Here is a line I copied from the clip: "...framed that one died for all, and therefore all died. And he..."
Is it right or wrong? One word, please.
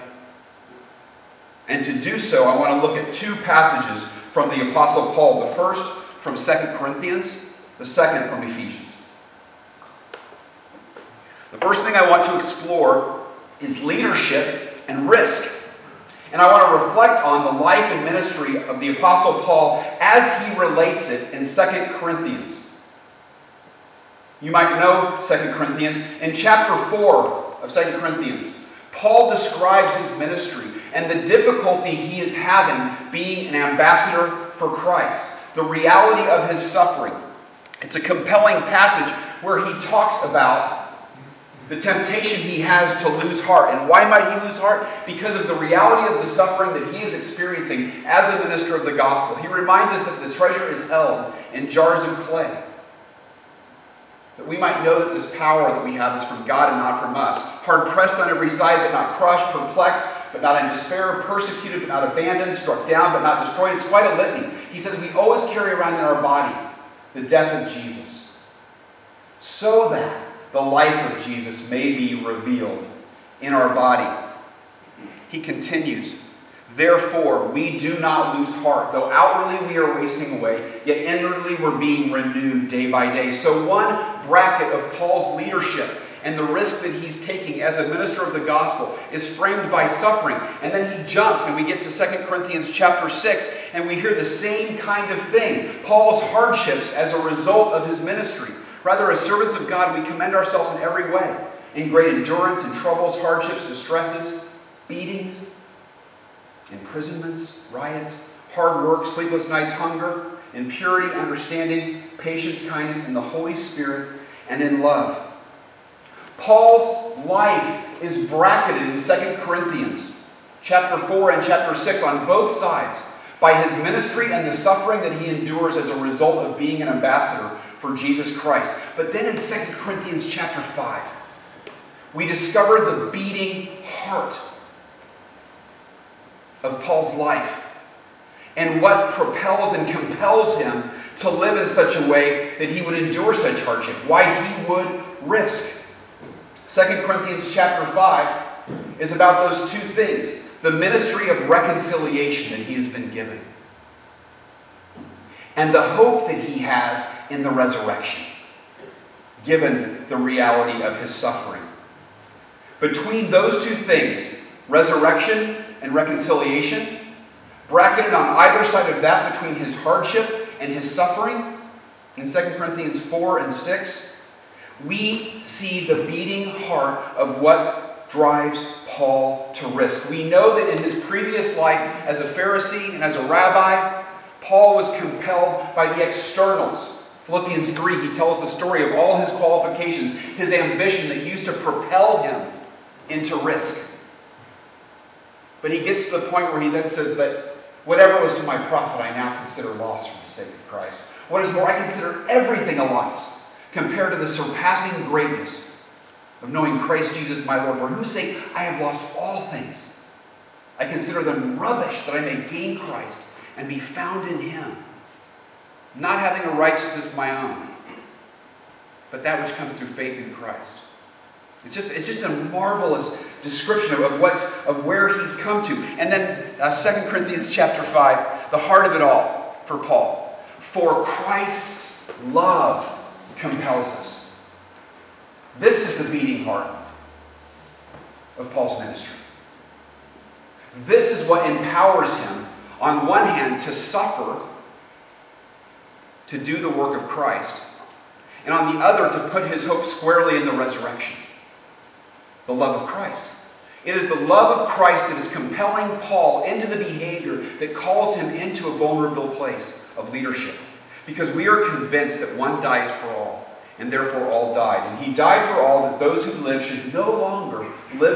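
wrong.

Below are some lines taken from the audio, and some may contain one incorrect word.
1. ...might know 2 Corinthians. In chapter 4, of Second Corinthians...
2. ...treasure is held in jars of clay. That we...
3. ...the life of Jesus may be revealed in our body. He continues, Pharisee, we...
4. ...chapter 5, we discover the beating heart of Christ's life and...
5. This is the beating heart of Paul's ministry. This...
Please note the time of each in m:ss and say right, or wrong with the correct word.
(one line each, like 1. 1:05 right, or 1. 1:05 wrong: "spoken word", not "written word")
1. 0:24 right
2. 0:50 right
3. 1:10 wrong: "Therefore", not "Pharisee"
4. 2:10 wrong: "Paul", not "Christ"
5. 3:55 right.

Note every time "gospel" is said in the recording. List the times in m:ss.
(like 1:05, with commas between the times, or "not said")
0:48, 1:28.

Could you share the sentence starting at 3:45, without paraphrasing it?
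And then uh, 2 Corinthians chapter 5, the heart of it all for Paul.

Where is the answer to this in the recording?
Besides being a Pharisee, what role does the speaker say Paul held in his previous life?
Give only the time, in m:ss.
3:03.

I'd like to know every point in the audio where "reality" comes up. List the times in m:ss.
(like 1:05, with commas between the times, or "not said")
0:35, 0:45, 2:40.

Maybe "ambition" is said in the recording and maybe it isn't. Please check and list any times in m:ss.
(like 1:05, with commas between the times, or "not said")
3:10.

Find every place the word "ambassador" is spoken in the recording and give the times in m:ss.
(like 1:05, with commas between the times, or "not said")
0:33, 2:06.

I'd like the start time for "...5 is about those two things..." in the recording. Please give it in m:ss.
2:27.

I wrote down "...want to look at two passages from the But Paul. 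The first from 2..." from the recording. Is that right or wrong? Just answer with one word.
wrong.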